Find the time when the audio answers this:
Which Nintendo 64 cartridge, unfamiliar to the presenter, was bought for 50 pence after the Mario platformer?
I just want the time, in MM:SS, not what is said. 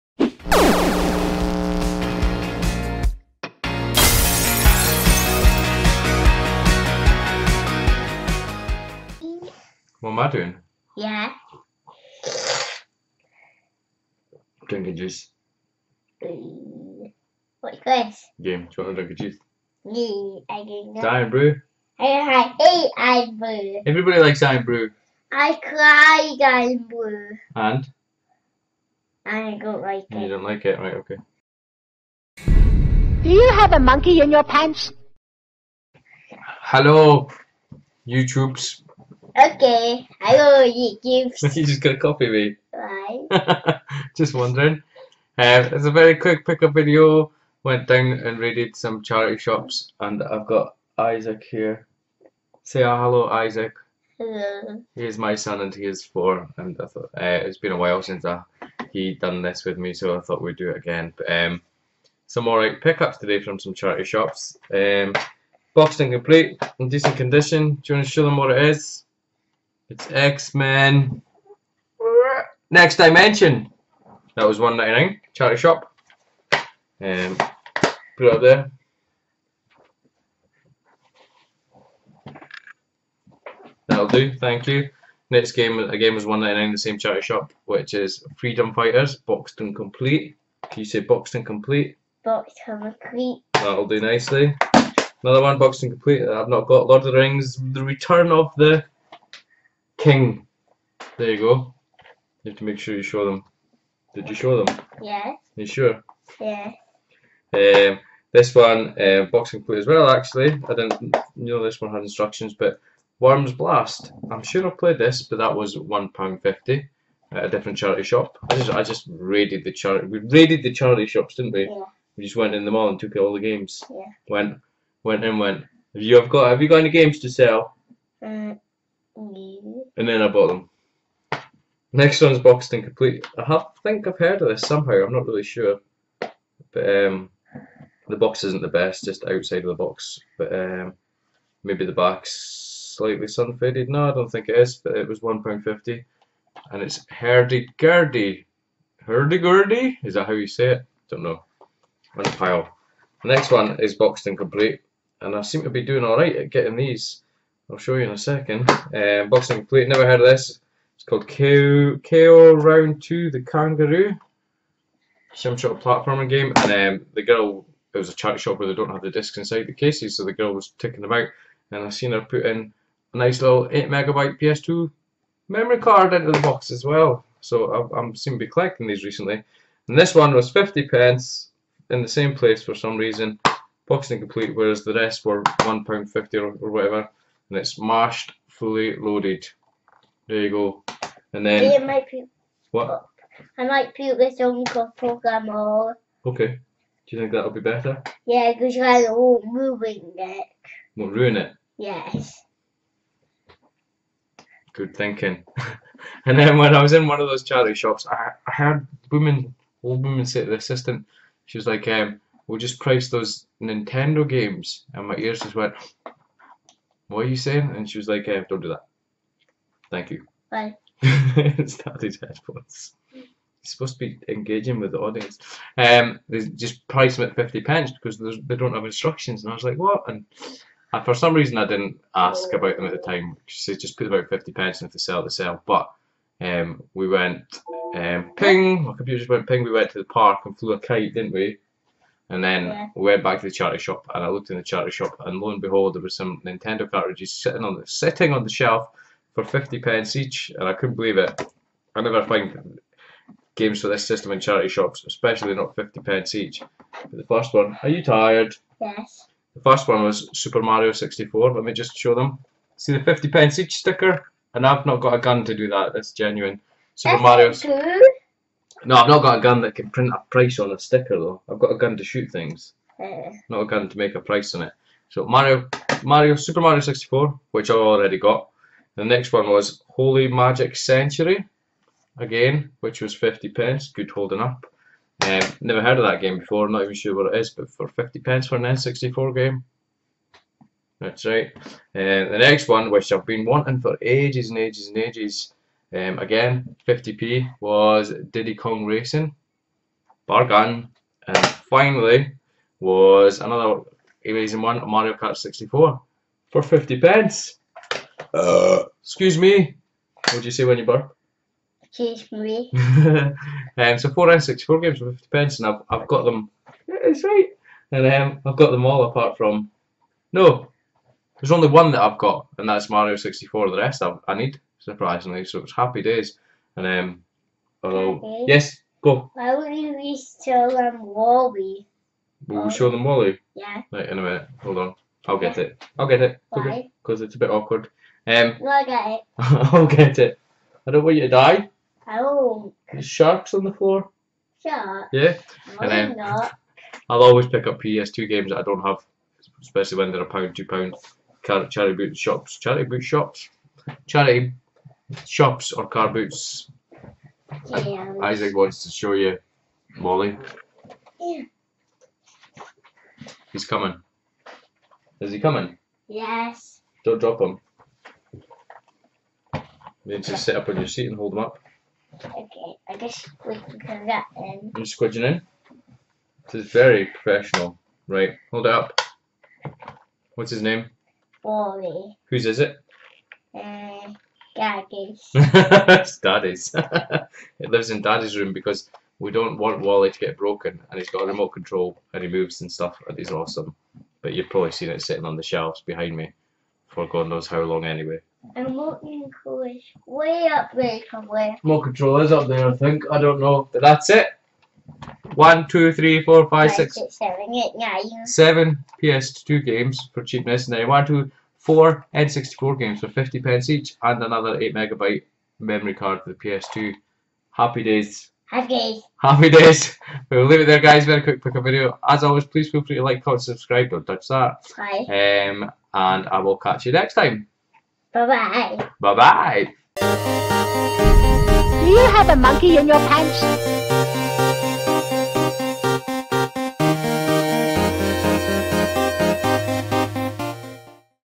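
04:39.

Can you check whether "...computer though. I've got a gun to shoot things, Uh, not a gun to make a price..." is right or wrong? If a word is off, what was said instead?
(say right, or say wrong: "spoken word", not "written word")
wrong: "sticker", not "computer".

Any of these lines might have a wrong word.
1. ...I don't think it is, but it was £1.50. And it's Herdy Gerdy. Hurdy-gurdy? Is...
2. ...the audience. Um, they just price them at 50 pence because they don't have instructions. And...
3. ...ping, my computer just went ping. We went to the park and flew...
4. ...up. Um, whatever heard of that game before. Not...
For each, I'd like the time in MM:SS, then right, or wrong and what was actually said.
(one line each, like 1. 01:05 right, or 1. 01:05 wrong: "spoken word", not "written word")
1. 02:24 right
2. 03:44 right
3. 03:58 right
4. 04:44 wrong: "never", not "whatever".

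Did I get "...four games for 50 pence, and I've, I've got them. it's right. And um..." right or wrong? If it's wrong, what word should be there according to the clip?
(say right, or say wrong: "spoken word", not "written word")
right.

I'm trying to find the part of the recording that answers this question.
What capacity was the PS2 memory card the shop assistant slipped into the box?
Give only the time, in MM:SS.
02:53.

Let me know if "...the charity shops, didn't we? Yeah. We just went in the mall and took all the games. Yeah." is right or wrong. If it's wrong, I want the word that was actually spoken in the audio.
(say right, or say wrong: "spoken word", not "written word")
right.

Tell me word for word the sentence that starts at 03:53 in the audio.
She just put about 50 pence and if they sell, they sell.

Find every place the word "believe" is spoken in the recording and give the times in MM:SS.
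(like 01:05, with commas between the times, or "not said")
04:10.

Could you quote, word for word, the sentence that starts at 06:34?
But you've probably seen it sitting on the shelves behind me for God knows how long anyway.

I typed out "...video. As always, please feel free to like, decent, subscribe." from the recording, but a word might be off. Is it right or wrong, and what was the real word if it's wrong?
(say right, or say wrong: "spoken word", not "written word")
wrong: "comment", not "decent".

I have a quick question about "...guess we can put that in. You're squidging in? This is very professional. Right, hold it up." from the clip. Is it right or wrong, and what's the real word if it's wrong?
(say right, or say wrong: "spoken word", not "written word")
right.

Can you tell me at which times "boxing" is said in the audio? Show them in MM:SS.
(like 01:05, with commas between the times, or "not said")
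01:49, 02:39, 03:03.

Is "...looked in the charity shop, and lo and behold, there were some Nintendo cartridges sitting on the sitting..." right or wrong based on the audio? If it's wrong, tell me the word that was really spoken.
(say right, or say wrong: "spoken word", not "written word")
right.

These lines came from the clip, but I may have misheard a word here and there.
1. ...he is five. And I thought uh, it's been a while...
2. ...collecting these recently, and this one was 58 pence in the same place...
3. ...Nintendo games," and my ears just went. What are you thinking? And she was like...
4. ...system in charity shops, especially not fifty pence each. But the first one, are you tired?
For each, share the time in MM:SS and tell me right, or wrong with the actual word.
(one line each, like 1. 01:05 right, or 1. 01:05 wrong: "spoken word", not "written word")
1. 00:55 wrong: "four", not "five"
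2. 02:58 wrong: "50", not "58"
3. 03:33 wrong: "saying", not "thinking"
4. 04:14 right.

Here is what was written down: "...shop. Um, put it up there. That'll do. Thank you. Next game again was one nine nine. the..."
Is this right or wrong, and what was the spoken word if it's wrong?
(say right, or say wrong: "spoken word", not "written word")
right.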